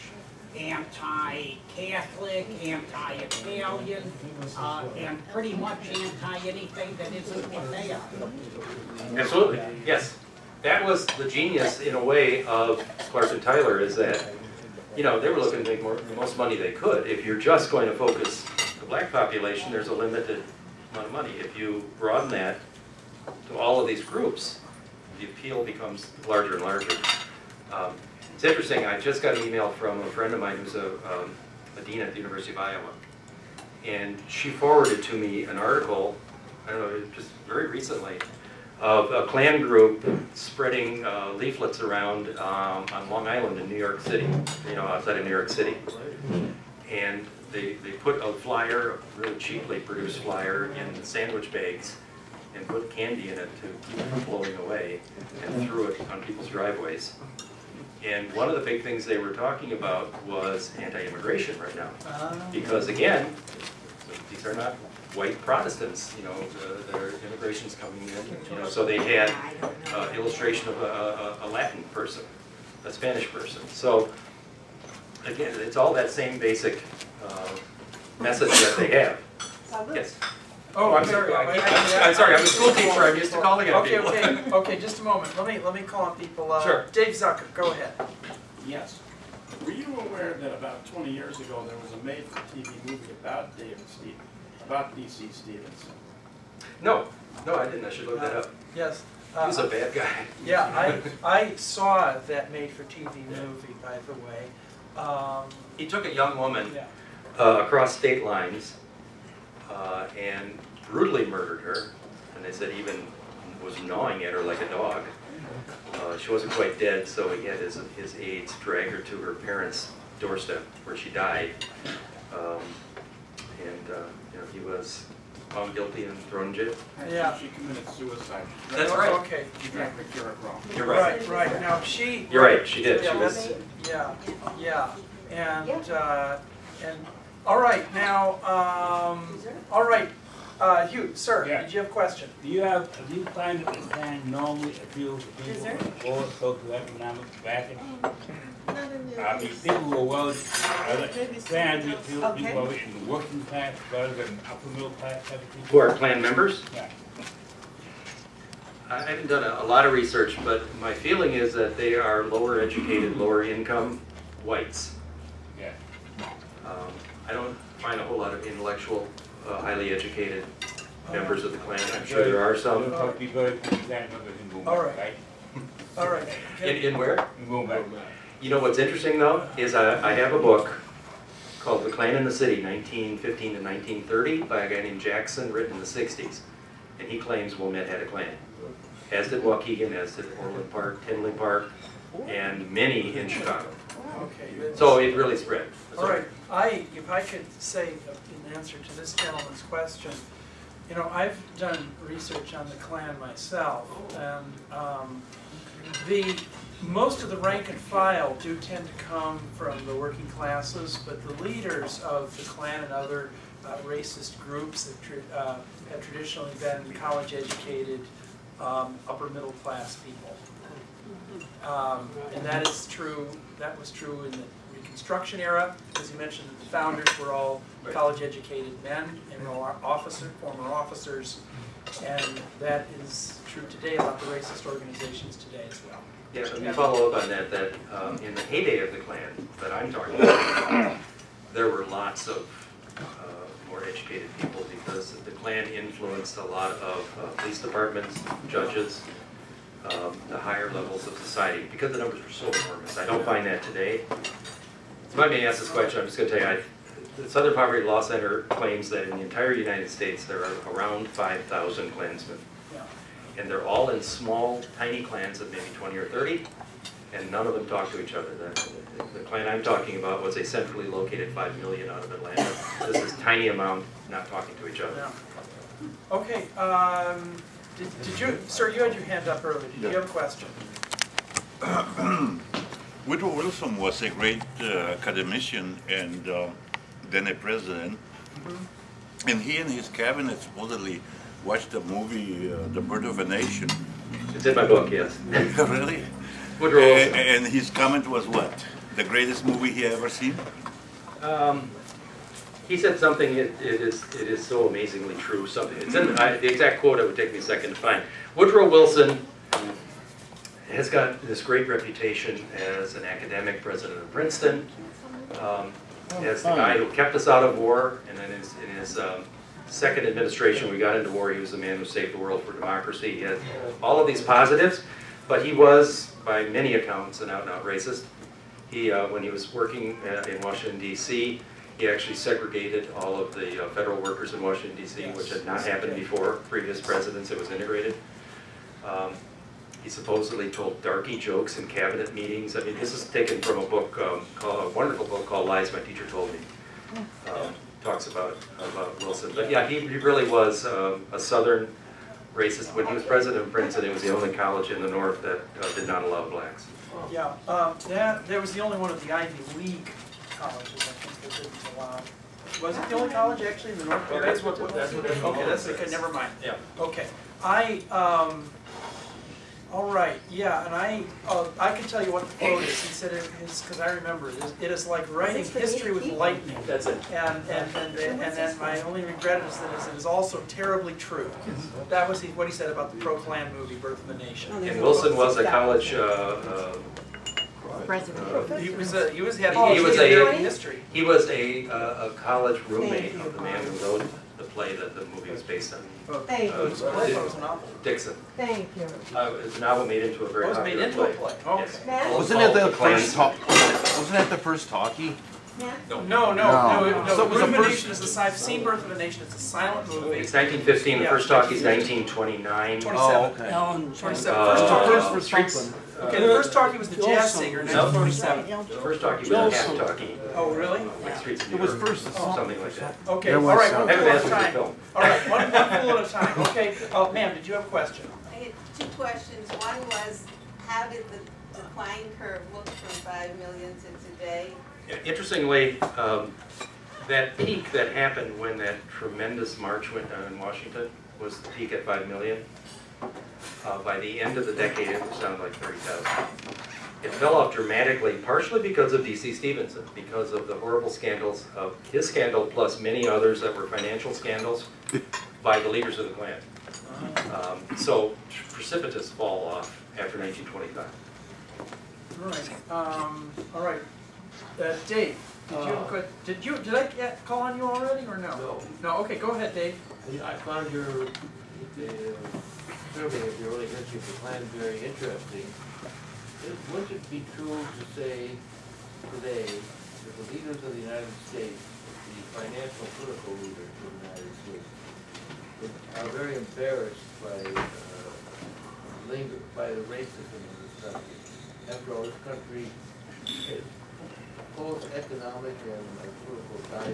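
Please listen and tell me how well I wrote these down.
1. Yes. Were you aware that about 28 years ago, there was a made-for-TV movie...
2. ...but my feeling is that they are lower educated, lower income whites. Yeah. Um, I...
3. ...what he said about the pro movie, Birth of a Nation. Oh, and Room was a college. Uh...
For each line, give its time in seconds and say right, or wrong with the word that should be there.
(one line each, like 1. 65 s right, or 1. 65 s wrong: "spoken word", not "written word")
1. 88 s wrong: "20", not "28"
2. 160 s right
3. 382 s wrong: "Wilson", not "Room".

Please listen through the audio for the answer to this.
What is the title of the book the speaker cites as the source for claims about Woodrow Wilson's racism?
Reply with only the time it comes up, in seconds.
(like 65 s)
345 s.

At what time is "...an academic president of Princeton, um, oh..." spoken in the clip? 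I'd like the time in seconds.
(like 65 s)
312 s.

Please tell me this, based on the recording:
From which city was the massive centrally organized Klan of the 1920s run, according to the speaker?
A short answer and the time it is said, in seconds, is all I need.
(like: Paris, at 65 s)
Atlanta, at 272 s.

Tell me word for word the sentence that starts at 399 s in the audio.
Uh, the novel made into a very.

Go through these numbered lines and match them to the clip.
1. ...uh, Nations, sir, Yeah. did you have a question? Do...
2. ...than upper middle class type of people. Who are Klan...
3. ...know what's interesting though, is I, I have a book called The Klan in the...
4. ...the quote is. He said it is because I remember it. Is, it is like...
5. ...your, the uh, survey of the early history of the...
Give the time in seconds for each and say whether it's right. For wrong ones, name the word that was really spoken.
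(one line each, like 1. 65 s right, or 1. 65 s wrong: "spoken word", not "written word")
1. 140 s wrong: "Hugh", not "Nations"
2. 154 s right
3. 178 s right
4. 372 s right
5. 470 s right.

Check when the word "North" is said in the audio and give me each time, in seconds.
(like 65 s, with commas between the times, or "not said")
354 s, 363 s.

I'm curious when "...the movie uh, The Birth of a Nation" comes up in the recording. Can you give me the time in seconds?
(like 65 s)
291 s.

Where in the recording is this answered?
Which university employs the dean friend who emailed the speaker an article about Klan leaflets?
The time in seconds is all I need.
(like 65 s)
32 s.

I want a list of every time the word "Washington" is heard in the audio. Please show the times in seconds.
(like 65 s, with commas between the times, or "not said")
330 s, 334 s, 440 s.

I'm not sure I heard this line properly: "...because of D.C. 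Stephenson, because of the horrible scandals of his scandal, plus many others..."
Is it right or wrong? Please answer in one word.
right.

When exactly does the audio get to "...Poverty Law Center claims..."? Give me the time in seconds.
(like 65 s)
257 s.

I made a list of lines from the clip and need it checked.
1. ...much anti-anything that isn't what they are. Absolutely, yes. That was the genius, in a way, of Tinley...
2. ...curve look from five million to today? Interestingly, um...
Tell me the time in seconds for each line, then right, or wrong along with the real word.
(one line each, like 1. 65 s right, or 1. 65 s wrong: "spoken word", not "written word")
1. 5 s wrong: "Clarke", not "Tinley"
2. 432 s right.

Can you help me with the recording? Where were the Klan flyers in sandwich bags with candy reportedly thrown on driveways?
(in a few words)
Long Island.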